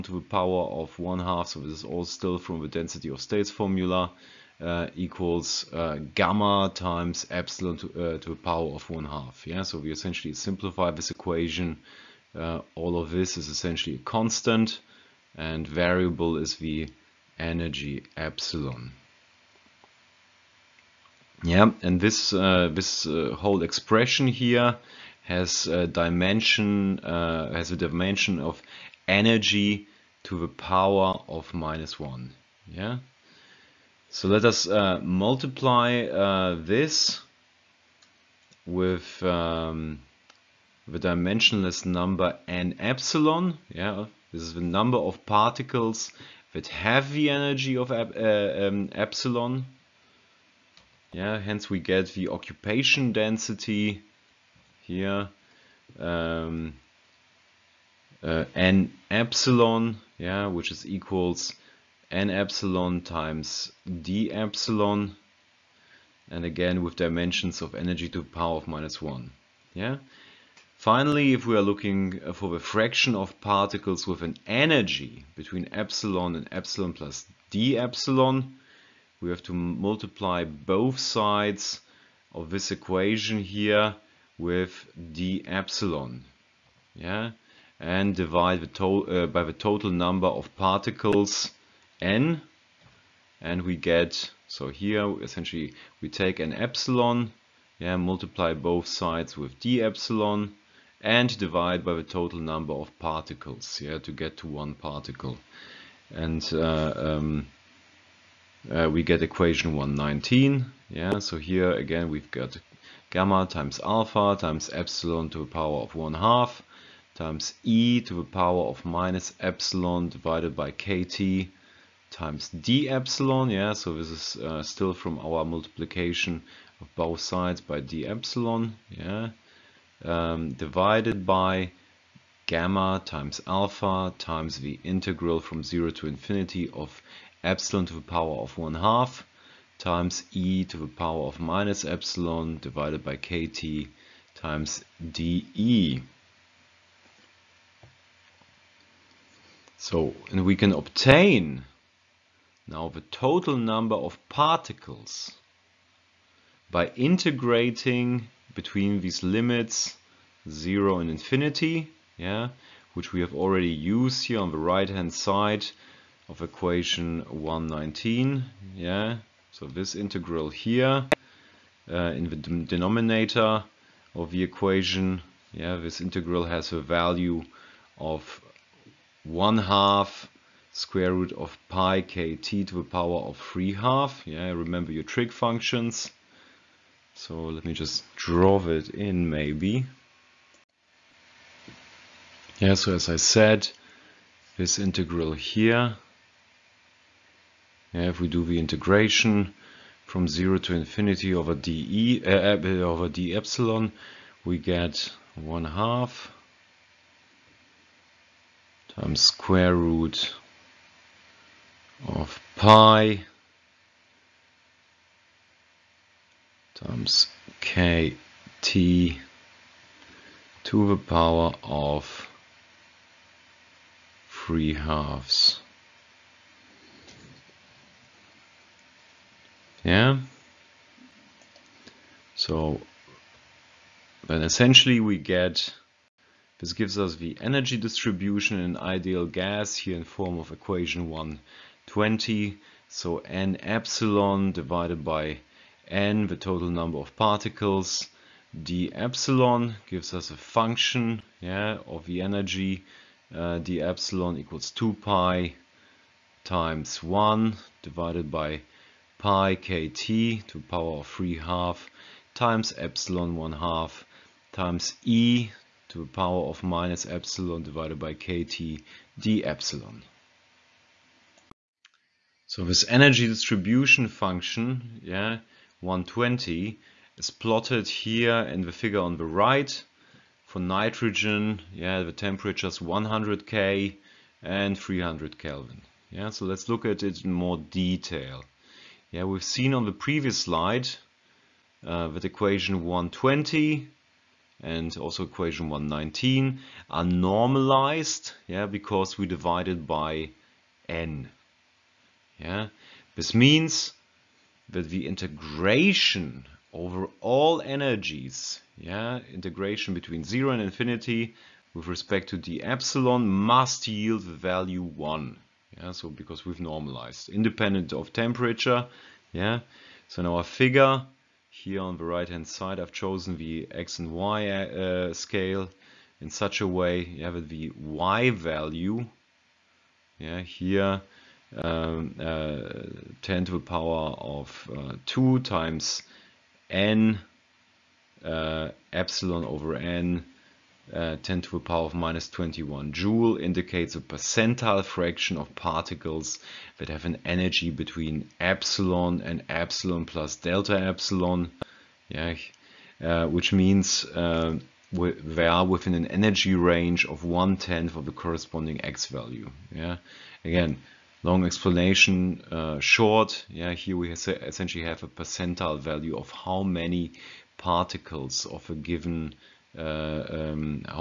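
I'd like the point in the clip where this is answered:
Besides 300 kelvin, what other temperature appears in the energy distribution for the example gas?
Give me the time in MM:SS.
04:42.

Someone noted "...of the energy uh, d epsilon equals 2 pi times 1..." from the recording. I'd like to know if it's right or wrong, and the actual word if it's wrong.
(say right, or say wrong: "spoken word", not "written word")
right.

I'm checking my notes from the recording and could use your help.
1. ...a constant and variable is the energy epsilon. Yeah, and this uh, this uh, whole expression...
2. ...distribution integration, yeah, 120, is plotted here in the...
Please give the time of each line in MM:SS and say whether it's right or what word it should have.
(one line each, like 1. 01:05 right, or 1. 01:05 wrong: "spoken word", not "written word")
1. 00:13 right
2. 04:33 wrong: "function", not "integration".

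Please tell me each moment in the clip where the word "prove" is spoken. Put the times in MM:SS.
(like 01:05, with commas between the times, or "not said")
not said.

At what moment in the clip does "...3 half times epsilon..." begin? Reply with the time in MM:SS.
04:21.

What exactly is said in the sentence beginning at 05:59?
Yeah, again, long explanation uh, short.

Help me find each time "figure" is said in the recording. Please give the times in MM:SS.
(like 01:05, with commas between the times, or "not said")
04:38, 05:20.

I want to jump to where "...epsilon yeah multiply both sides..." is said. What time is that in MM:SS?
01:36.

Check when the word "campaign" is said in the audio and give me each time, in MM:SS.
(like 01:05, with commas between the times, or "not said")
not said.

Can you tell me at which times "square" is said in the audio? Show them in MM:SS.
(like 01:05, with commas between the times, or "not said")
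03:00, 03:29.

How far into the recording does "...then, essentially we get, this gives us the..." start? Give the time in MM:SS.
03:54.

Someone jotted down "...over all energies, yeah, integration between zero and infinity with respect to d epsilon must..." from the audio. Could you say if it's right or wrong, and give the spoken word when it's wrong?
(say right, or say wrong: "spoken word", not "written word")
right.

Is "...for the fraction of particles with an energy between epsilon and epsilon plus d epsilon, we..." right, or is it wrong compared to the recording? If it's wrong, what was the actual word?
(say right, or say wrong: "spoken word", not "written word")
right.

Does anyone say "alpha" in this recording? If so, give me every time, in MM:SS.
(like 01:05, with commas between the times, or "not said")
01:53, 02:13.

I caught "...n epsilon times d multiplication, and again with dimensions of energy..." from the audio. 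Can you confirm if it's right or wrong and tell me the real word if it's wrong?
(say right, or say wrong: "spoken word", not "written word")
wrong: "epsilon", not "multiplication".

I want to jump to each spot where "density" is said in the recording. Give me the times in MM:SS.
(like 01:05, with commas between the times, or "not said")
00:02, 00:53.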